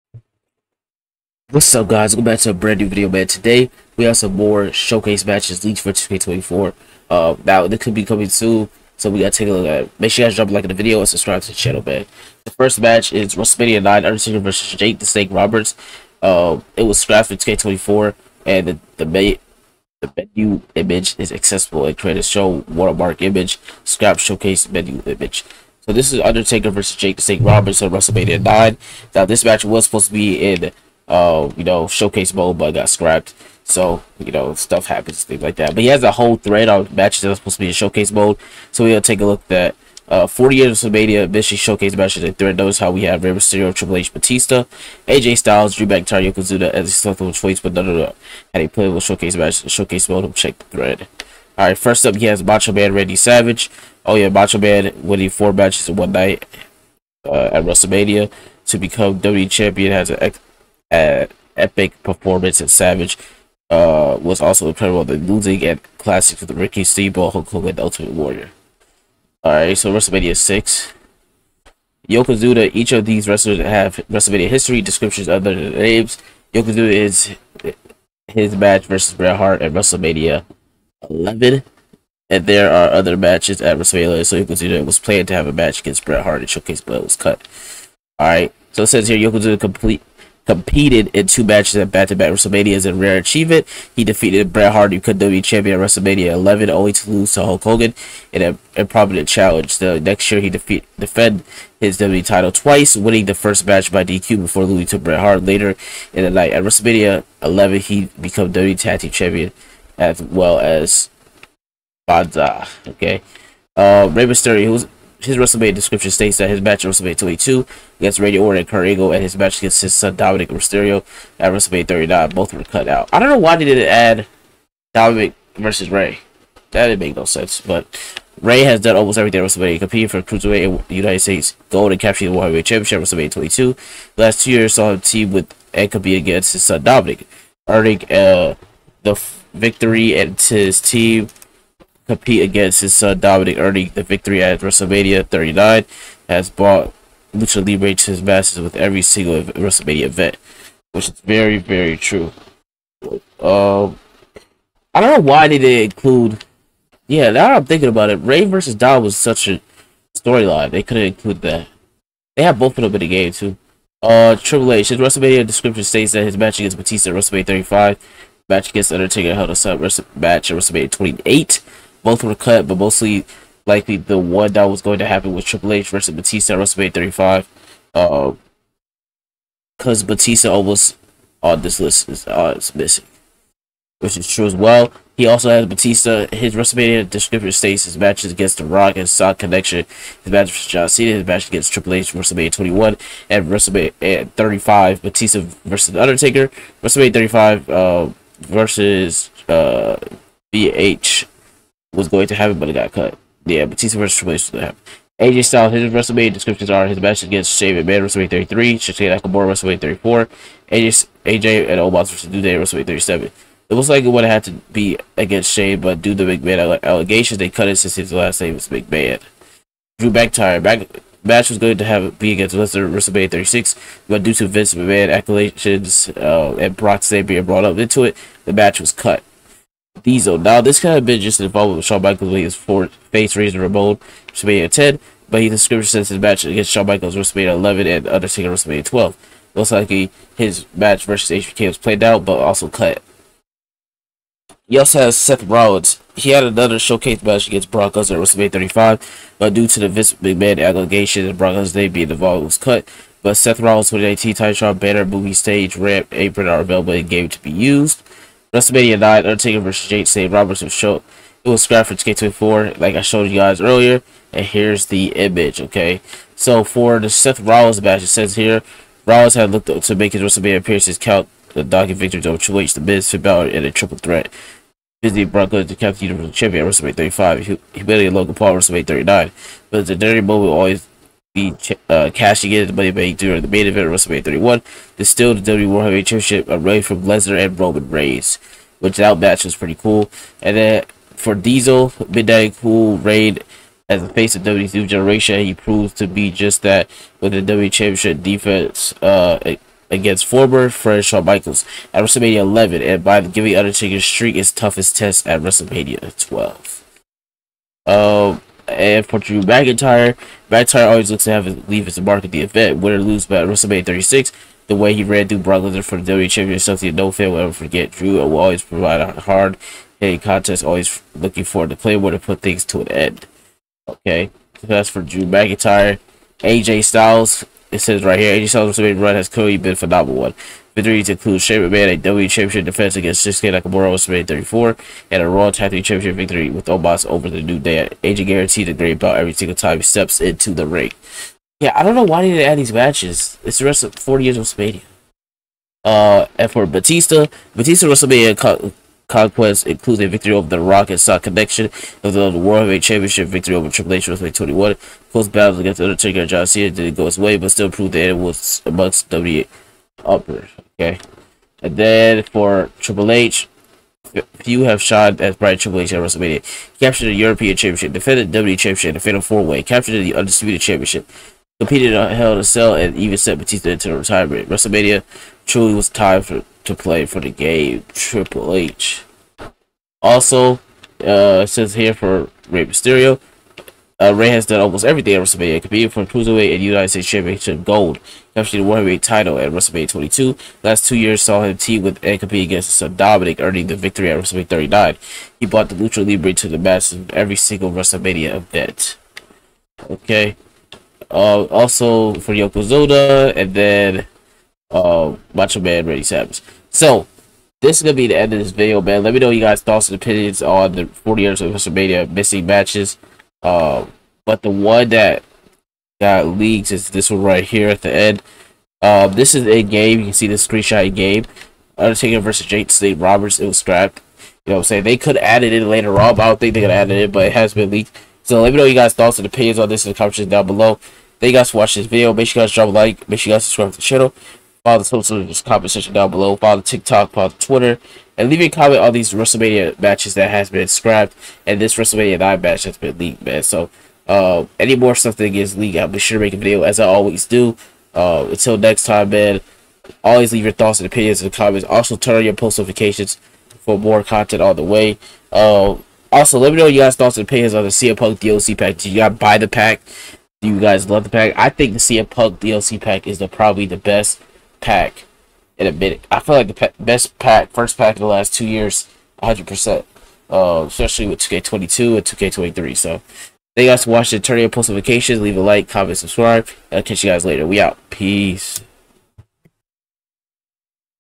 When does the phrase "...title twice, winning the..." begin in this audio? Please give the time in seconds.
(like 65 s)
102 s.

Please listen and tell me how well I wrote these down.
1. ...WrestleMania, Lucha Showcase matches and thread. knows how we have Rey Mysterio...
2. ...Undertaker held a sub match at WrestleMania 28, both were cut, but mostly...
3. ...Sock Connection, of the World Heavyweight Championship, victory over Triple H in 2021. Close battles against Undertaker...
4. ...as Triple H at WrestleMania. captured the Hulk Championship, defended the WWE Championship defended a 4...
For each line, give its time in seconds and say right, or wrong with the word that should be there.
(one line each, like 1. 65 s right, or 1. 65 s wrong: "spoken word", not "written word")
1. 40 s wrong: "Mission", not "Lucha"
2. 168 s right
3. 350 s right
4. 365 s wrong: "European", not "Hulk".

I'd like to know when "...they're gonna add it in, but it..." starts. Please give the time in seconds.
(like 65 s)
426 s.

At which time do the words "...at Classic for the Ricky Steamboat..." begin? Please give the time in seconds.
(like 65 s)
65 s.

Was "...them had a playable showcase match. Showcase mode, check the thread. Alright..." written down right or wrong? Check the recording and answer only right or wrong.
right.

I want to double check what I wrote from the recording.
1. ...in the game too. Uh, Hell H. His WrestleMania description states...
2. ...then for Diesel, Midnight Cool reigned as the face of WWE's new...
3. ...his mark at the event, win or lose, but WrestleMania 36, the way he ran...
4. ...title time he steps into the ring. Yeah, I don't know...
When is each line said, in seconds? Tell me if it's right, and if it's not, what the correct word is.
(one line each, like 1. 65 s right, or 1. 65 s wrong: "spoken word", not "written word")
1. 162 s wrong: "Triple", not "Hell"
2. 290 s right
3. 311 s right
4. 339 s wrong: "single", not "title".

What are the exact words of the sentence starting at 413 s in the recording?
Uh, but the one that got leaked is this one right here at the end.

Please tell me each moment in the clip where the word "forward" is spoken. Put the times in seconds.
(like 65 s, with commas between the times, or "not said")
321 s.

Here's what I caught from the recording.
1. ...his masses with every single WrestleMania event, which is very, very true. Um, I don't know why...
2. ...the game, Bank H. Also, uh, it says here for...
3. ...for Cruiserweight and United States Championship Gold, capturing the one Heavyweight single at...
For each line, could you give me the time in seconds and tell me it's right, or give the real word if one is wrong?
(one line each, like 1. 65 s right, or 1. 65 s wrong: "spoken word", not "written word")
1. 148 s right
2. 377 s wrong: "Triple", not "Bank"
3. 385 s wrong: "title", not "single".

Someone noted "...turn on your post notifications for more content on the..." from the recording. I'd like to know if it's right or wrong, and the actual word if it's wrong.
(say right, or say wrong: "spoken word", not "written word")
right.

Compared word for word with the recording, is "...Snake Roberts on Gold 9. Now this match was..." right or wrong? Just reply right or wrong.
wrong.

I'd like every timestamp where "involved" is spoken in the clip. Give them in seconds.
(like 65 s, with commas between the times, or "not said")
231 s, 252 s.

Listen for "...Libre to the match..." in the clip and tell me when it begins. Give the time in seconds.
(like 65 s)
396 s.